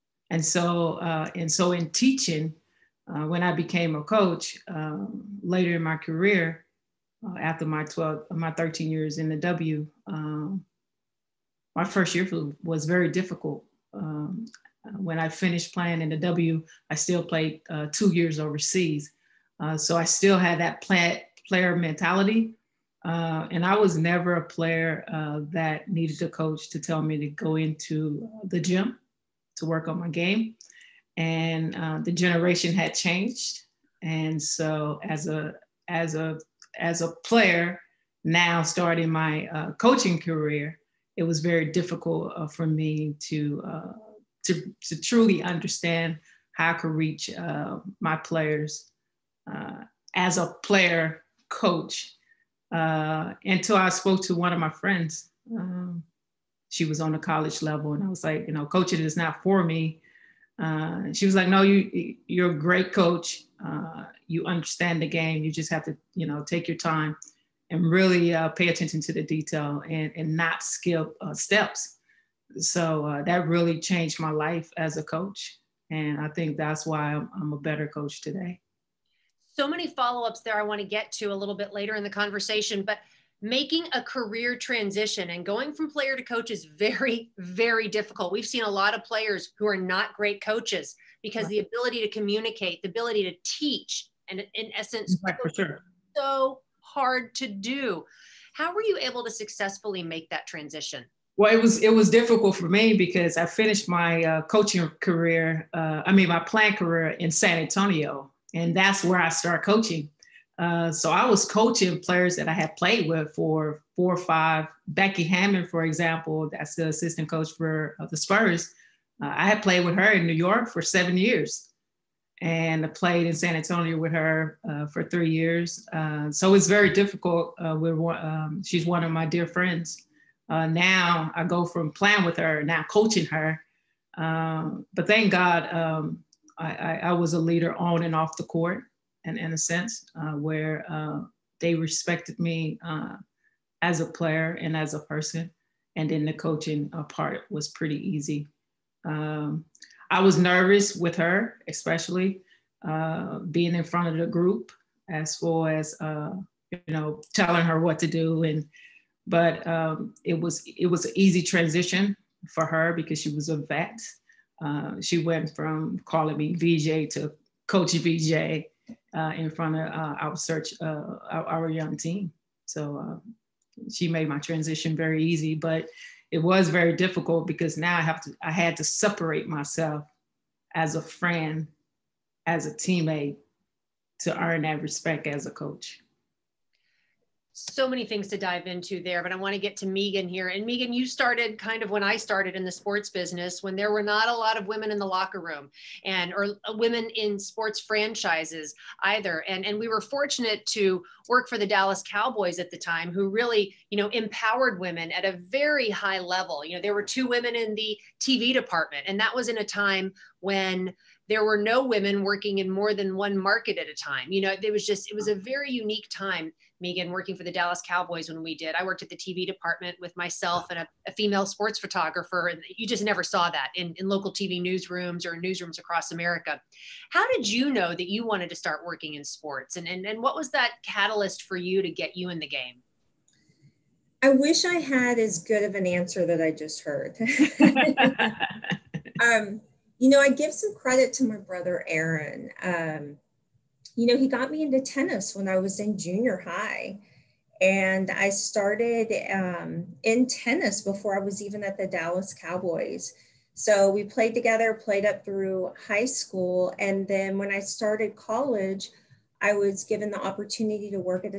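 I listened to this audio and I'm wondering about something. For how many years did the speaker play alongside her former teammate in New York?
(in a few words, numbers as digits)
7.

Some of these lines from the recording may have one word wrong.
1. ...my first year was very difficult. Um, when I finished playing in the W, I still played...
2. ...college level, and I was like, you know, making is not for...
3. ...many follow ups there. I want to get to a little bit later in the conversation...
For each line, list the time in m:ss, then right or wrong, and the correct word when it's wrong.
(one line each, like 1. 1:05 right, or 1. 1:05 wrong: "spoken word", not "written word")
1. 0:11 right
2. 0:57 wrong: "coaching", not "making"
3. 1:19 right.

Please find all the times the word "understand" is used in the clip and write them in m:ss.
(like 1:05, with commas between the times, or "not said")
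0:45, 1:04.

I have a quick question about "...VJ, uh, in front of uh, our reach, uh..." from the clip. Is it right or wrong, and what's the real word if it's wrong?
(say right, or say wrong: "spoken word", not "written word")
wrong: "search", not "reach".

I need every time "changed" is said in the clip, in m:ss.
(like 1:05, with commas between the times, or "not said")
0:32, 1:13.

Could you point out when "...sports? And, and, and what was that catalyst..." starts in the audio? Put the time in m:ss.
3:49.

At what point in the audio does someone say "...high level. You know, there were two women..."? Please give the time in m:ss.
3:25.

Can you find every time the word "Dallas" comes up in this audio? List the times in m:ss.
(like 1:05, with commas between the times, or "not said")
3:21, 3:37, 4:11.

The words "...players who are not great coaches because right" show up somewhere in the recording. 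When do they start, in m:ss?
1:29.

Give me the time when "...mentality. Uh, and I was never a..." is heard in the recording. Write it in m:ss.
0:21.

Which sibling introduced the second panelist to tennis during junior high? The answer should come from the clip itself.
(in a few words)
Aaron.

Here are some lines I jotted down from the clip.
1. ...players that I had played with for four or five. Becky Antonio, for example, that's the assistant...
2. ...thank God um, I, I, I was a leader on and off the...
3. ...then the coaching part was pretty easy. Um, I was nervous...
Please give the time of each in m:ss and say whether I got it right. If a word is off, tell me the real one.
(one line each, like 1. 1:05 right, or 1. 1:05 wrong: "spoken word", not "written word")
1. 1:51 wrong: "Hammon", not "Antonio"
2. 2:15 right
3. 2:26 right.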